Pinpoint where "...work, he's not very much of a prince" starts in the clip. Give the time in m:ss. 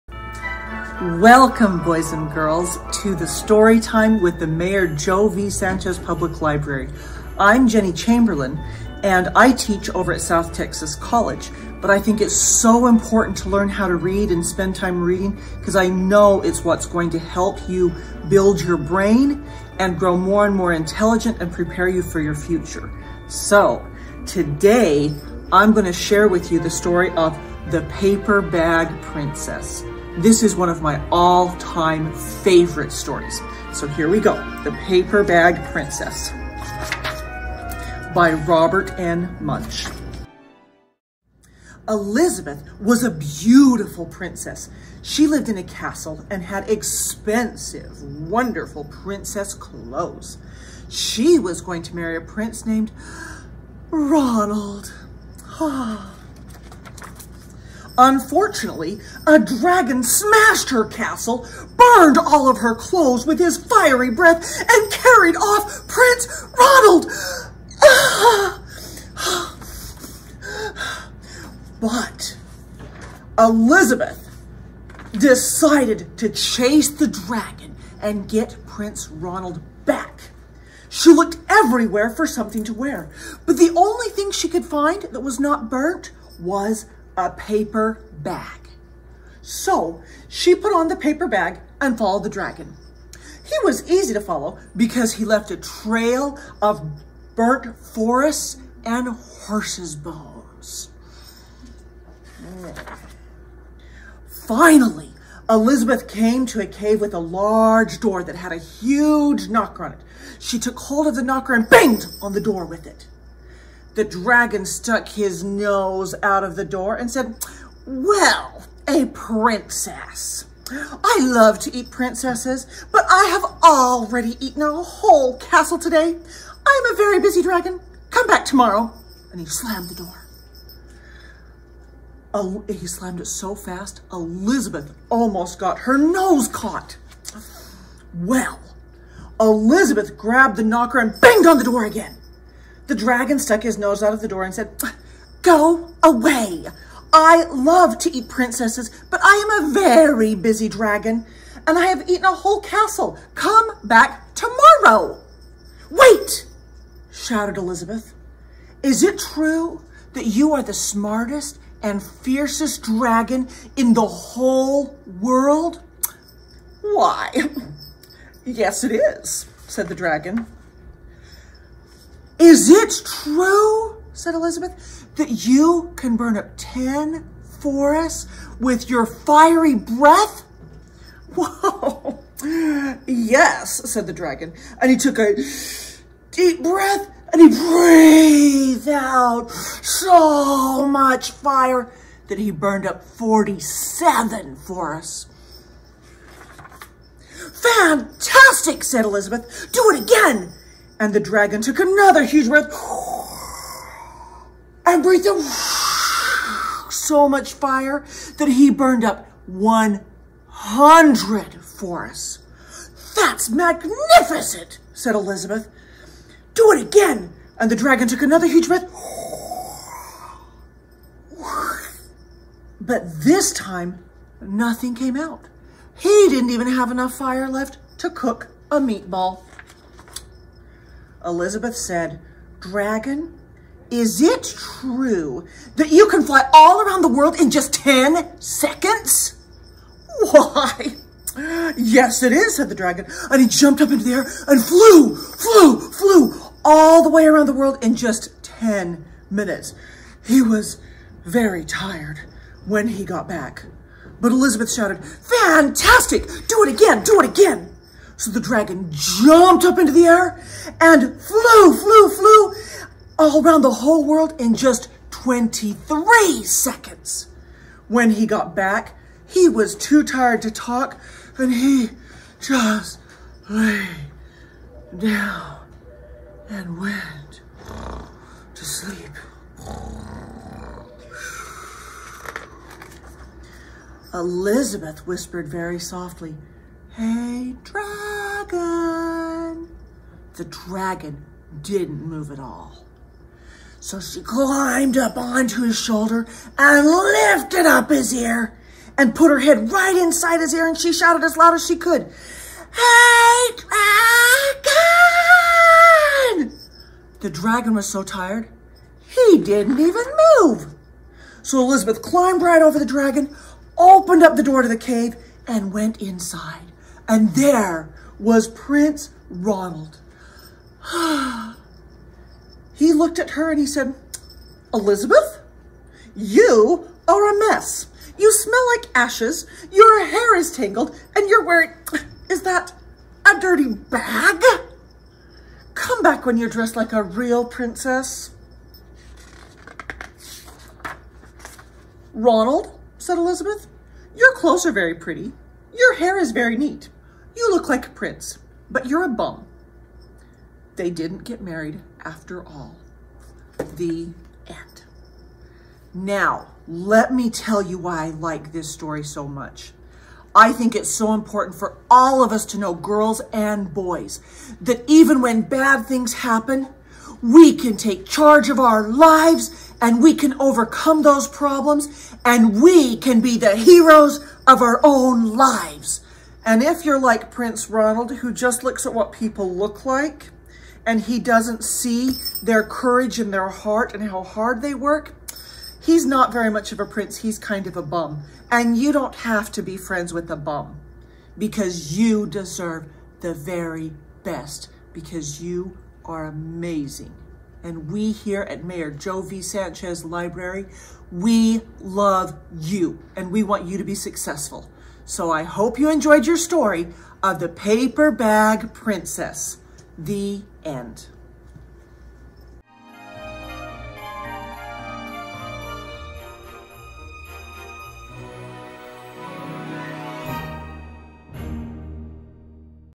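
6:24.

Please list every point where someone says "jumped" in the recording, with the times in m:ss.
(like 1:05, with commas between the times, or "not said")
4:03, 4:18.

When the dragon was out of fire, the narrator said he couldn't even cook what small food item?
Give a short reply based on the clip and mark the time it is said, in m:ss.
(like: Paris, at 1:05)
A meatball, at 3:48.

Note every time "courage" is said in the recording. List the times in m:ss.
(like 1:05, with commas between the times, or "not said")
6:22.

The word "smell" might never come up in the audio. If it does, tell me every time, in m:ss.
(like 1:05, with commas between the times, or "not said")
5:28.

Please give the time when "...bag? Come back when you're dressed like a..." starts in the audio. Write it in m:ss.
5:33.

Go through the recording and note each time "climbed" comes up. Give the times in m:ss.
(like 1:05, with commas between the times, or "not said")
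4:54, 5:12.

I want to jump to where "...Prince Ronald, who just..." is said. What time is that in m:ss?
6:17.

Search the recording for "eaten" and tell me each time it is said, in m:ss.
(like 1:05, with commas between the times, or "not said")
2:04, 2:32.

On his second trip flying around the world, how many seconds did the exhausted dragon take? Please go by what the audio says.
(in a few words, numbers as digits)
23.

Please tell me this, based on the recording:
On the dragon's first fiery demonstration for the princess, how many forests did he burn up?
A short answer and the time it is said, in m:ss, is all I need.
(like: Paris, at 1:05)
47, at 3:13.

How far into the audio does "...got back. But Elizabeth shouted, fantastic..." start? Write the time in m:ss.
4:13.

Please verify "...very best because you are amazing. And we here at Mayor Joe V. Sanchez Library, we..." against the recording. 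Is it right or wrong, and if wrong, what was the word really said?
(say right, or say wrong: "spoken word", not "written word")
right.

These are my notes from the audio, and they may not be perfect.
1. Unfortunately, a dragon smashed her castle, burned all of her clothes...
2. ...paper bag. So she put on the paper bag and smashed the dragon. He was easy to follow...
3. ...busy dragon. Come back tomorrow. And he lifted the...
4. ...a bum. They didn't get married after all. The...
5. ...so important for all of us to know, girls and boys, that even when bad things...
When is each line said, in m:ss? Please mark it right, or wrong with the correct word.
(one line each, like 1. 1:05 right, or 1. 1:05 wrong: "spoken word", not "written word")
1. 0:58 right
2. 1:27 wrong: "followed", not "smashed"
3. 2:07 wrong: "slammed", not "lifted"
4. 5:49 right
5. 6:00 right.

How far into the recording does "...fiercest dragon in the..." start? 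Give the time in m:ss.
2:42.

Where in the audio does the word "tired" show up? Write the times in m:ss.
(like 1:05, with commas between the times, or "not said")
4:11, 4:30, 5:08.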